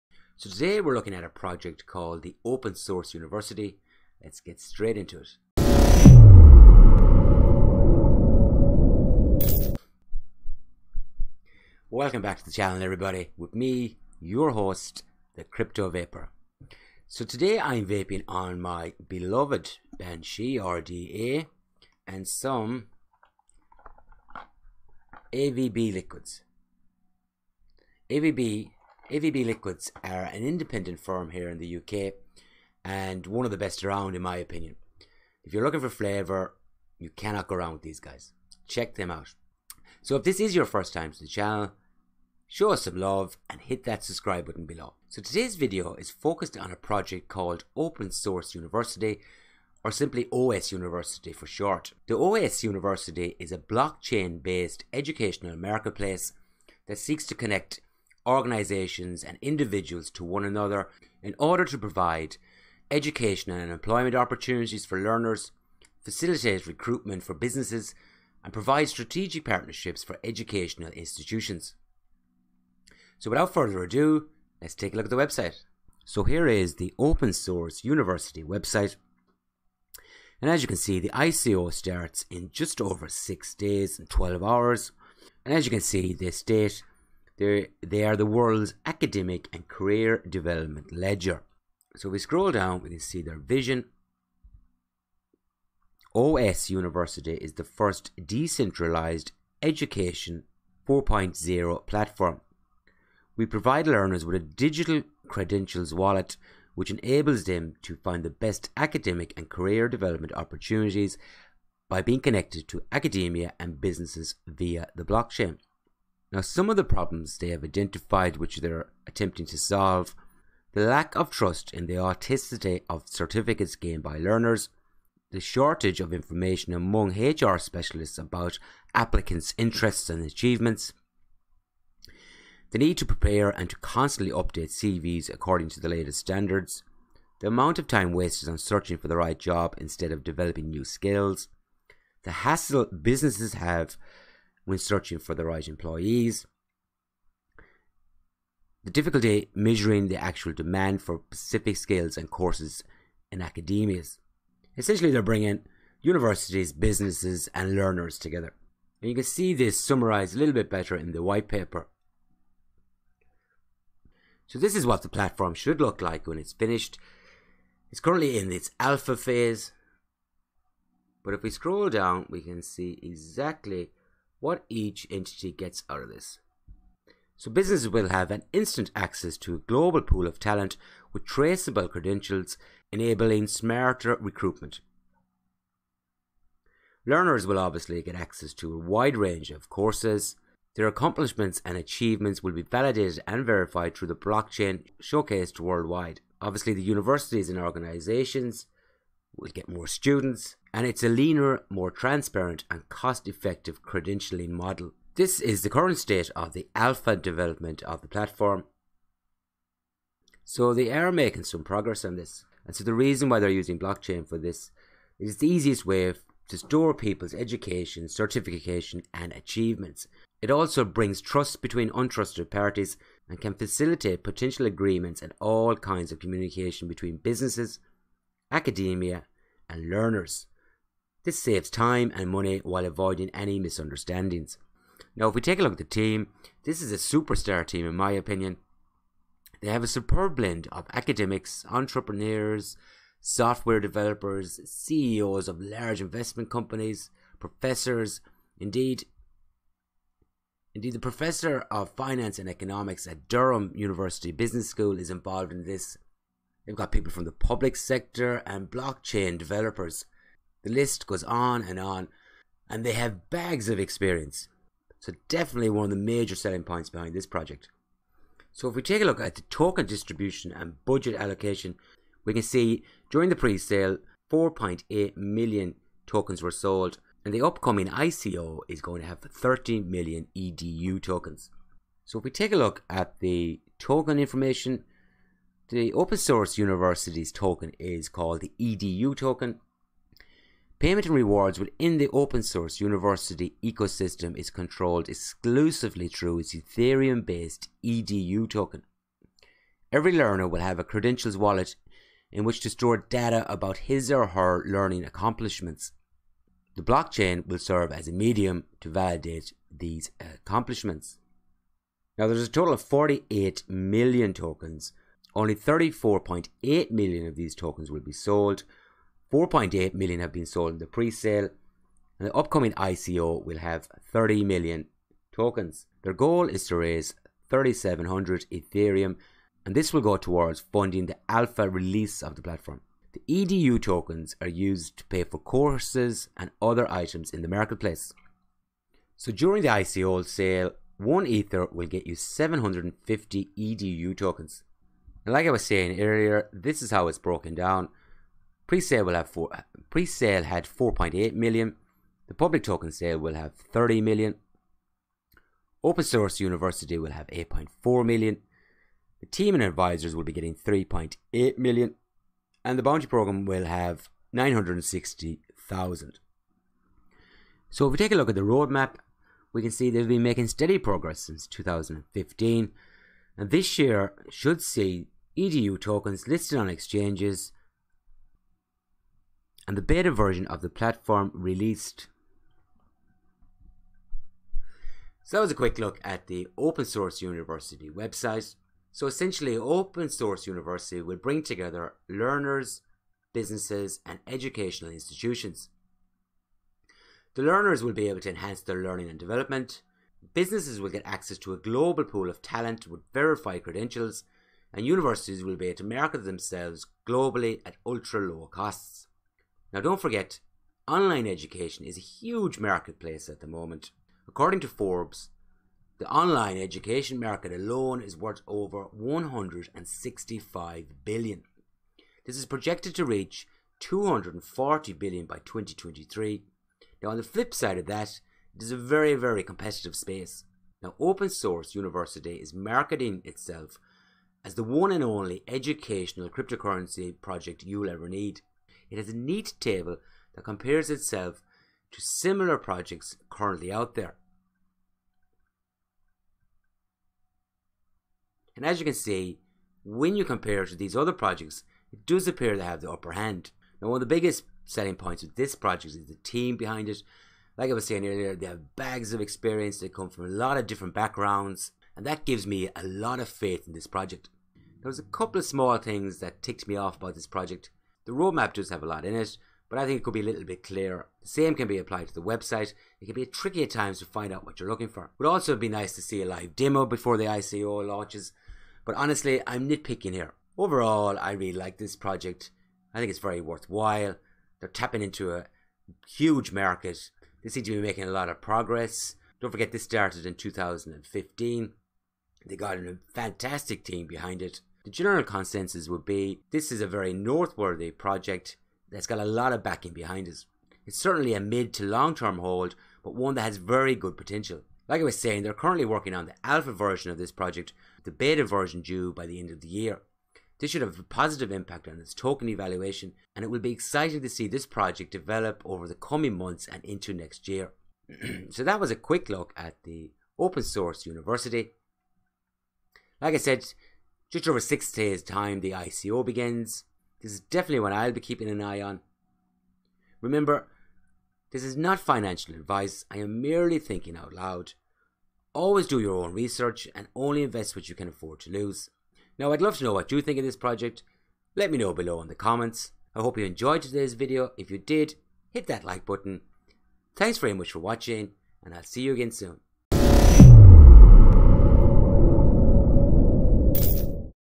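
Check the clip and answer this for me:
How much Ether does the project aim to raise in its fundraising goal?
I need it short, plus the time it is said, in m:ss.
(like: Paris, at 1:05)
3700 Ethereum, at 5:27.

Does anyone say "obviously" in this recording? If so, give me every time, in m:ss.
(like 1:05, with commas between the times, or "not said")
3:07, 3:16.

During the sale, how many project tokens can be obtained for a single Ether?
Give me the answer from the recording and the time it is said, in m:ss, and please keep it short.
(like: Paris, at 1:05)
750, at 5:42.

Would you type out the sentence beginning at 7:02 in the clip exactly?
This is projected to reach 240 billion by 2023.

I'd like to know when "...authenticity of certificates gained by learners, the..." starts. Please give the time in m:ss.
2:01.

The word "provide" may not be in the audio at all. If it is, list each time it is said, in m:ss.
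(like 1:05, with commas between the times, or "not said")
1:01, 1:08, 1:43.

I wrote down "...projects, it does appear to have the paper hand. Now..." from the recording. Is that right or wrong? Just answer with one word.
wrong.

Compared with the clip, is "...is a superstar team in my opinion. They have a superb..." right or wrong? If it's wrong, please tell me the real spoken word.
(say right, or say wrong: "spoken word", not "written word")
right.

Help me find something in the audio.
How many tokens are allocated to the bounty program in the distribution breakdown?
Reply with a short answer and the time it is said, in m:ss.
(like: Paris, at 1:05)
960,000, at 6:04.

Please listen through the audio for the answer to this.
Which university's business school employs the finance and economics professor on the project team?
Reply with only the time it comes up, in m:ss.
4:13.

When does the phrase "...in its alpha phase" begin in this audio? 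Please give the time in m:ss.
2:48.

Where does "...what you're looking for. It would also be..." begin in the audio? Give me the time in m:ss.
7:54.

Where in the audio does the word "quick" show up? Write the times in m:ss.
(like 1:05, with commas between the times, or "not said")
6:25, 8:38.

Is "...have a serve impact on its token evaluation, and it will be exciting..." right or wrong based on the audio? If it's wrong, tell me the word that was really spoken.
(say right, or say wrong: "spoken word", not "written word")
wrong: "positive", not "serve".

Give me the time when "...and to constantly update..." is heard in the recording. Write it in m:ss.
2:13.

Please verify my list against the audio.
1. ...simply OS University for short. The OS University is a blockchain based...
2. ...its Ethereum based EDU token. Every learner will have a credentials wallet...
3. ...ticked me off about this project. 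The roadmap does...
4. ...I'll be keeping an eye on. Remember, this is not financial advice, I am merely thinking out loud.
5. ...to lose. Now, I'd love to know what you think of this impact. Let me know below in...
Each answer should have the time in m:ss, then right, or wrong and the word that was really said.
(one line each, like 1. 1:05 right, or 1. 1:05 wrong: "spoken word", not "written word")
1. 0:49 right
2. 4:56 right
3. 7:46 right
4. 8:47 right
5. 8:58 wrong: "project", not "impact".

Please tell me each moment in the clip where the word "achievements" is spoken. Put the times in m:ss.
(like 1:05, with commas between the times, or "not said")
2:10, 3:11, 3:39.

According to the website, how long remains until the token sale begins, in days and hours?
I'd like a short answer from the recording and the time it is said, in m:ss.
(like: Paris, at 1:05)
6 days and 12 hours, at 1:23.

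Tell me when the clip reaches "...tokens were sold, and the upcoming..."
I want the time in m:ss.
4:36.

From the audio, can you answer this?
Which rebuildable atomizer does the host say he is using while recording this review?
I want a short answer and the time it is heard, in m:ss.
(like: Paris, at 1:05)
Banshee RDA, at 0:19.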